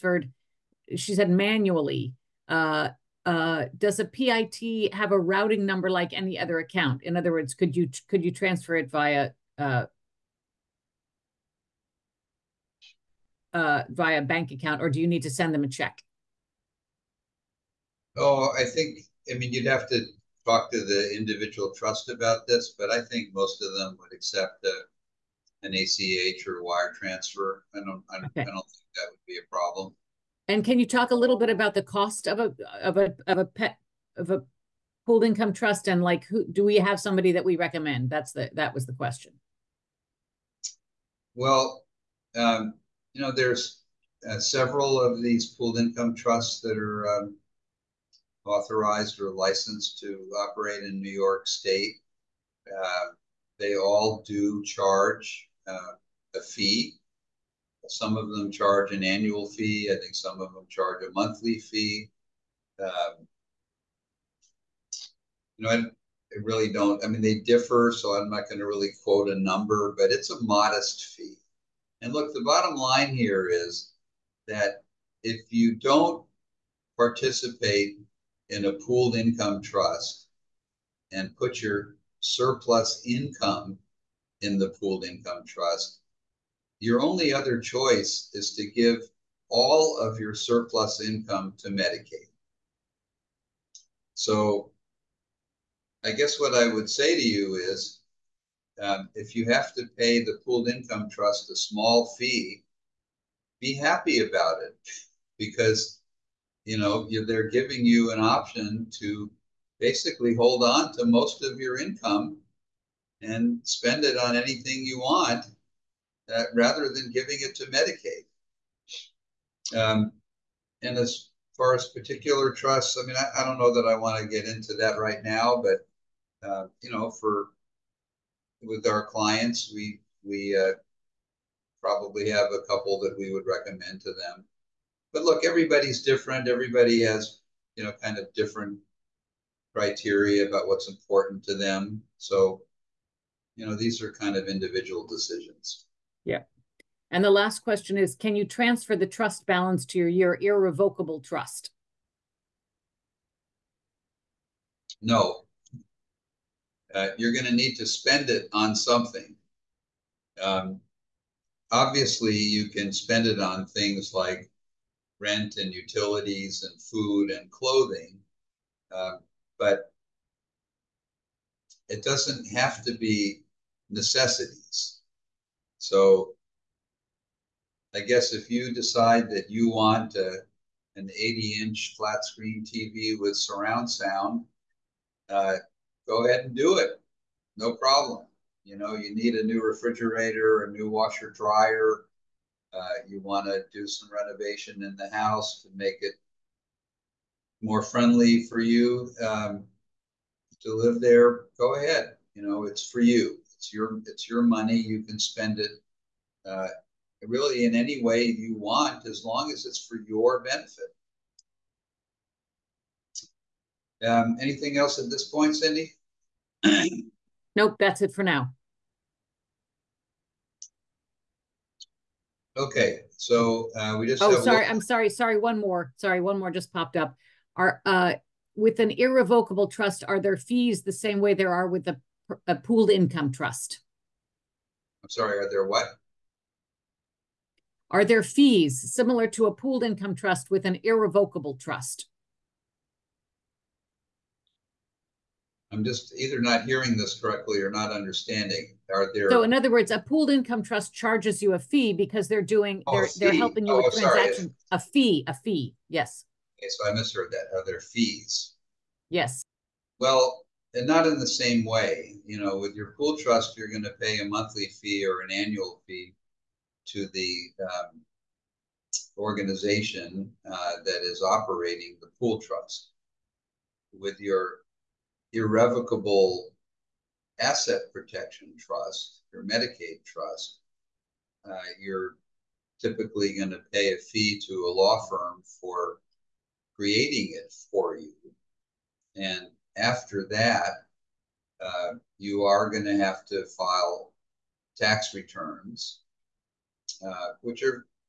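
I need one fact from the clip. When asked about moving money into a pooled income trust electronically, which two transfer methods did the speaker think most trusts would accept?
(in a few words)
ACH or wire transfer.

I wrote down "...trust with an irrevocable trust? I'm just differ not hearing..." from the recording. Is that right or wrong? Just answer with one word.
wrong.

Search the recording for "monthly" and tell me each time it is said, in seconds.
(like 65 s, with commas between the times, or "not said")
61 s, 264 s.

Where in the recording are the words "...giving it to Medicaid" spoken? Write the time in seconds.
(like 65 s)
117 s.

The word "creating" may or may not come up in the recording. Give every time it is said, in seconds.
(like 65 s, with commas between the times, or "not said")
286 s.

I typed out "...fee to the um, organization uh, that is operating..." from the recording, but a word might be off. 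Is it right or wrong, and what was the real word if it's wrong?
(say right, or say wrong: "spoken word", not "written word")
right.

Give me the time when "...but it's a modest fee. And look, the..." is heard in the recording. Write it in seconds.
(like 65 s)
69 s.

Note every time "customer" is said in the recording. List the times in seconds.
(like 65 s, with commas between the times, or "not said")
not said.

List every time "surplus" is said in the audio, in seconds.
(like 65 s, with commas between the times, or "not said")
82 s, 90 s.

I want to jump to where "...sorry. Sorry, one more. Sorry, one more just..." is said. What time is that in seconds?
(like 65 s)
224 s.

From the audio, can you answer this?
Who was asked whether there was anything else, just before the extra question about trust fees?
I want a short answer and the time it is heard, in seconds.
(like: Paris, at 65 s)
Cindy, at 215 s.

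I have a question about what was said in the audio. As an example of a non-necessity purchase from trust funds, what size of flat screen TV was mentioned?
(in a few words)
80 inch.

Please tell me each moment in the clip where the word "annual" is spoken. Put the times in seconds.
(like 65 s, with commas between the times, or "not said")
59 s, 265 s.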